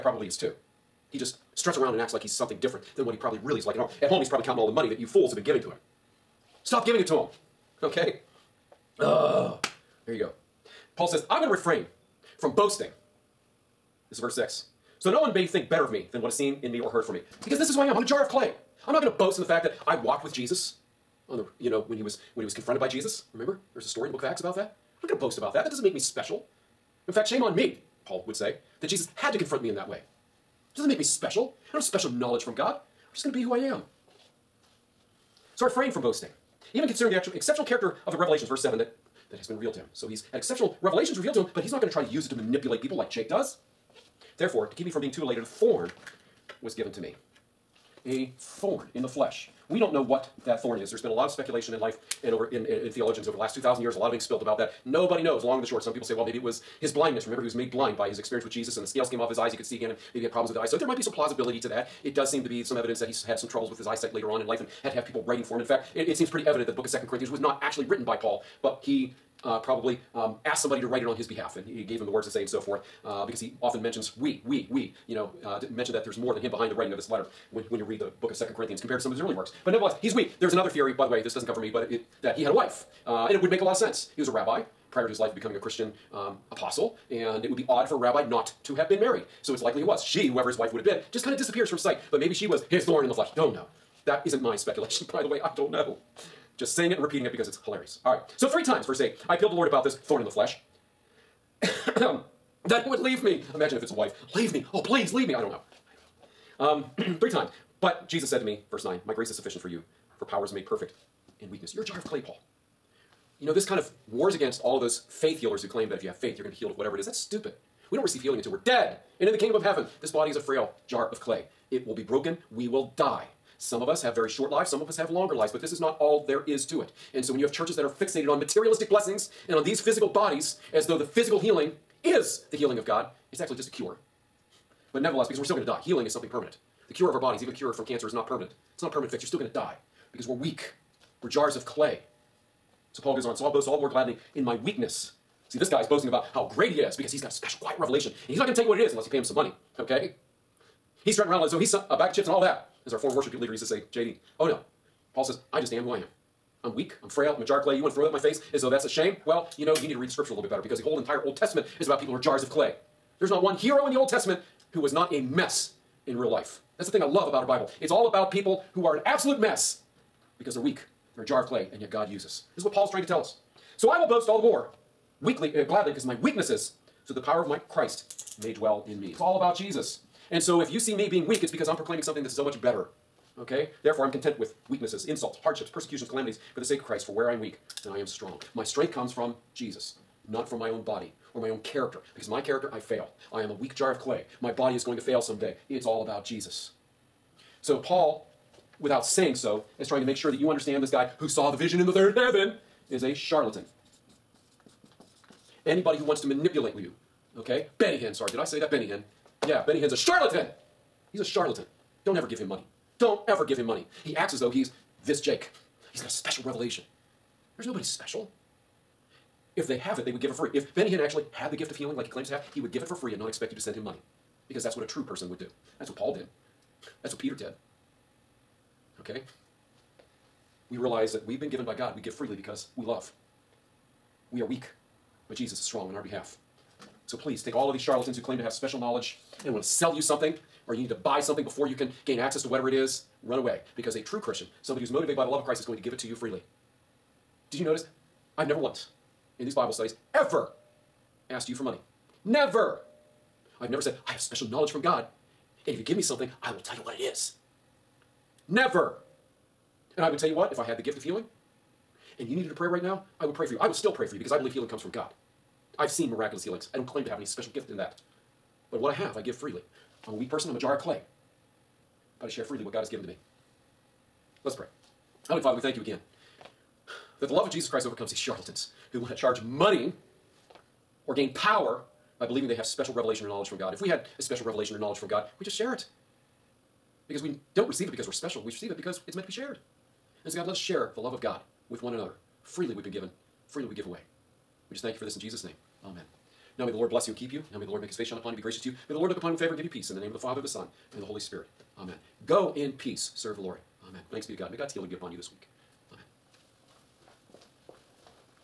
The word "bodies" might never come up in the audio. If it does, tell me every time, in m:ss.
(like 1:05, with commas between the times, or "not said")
2:10, 2:17.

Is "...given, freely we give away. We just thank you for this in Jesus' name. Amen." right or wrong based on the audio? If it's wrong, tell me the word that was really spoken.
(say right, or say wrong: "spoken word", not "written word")
right.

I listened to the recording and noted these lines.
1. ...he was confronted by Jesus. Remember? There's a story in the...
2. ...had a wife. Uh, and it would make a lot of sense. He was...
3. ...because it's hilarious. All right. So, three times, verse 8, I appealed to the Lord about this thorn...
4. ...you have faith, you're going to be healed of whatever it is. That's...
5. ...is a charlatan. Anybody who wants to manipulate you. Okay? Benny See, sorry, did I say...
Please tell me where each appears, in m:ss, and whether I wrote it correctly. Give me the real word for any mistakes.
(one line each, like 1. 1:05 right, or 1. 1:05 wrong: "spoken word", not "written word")
1. 0:22 right
2. 1:22 right
3. 1:37 right
4. 1:56 right
5. 3:22 wrong: "Hinn", not "See".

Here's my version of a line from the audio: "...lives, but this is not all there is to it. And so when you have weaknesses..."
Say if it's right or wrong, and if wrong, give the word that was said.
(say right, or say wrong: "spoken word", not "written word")
wrong: "churches", not "weaknesses".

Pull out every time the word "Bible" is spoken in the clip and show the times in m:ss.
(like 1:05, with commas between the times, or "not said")
2:47, 4:09.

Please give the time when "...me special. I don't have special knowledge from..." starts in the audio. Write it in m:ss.
0:30.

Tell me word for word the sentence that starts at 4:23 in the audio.
I will still pray for you because I believe healing comes from God.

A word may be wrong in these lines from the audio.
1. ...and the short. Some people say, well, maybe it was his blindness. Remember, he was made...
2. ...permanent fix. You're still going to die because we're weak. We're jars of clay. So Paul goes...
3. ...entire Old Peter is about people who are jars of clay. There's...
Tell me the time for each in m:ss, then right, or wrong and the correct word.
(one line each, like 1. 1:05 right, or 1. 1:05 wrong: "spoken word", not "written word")
1. 0:55 right
2. 2:18 right
3. 2:40 wrong: "Testament", not "Peter".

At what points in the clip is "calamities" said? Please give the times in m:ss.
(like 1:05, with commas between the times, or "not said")
3:06.